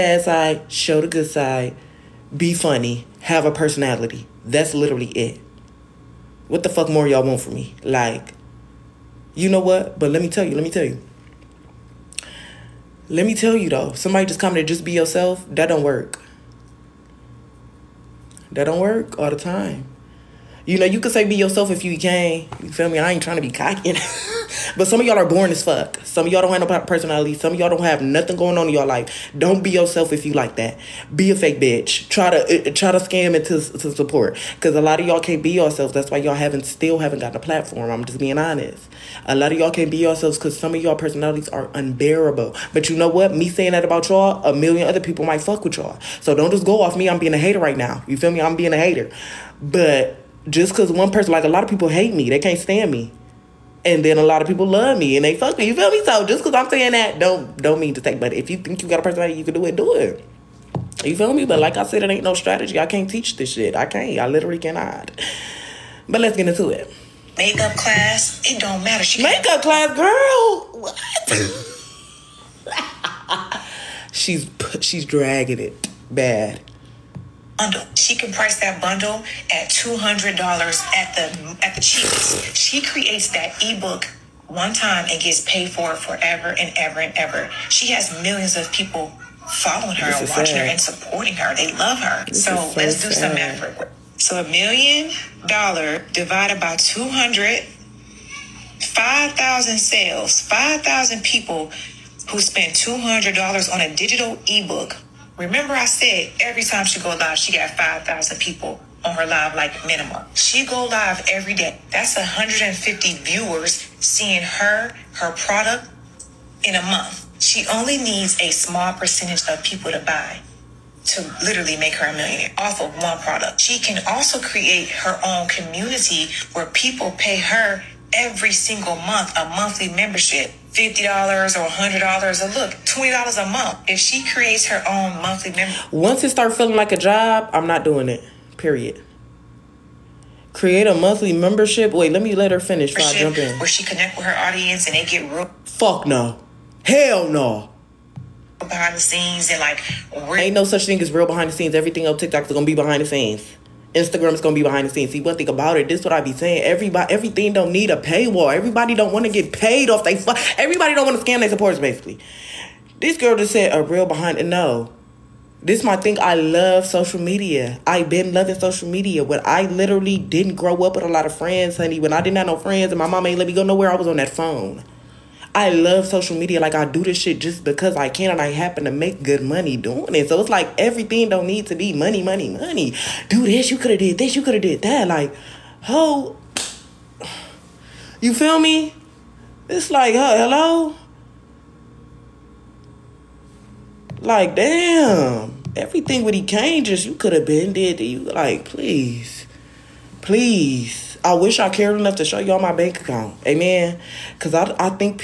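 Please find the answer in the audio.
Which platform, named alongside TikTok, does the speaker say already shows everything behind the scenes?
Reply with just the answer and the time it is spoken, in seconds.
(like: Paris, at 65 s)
Instagram, at 153 s.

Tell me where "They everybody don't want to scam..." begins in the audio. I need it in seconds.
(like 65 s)
160 s.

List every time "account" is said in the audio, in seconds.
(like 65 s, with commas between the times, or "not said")
202 s.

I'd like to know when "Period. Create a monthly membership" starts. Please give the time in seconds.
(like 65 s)
138 s.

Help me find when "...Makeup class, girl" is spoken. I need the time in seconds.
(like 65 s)
69 s.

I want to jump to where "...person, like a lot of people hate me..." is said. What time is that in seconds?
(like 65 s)
51 s.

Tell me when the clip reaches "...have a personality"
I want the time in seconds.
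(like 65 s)
3 s.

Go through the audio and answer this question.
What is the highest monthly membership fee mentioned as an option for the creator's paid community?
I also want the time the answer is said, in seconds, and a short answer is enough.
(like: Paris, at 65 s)
$100, at 131 s.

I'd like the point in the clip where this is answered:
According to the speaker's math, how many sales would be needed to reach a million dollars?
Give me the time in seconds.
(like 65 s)
98 s.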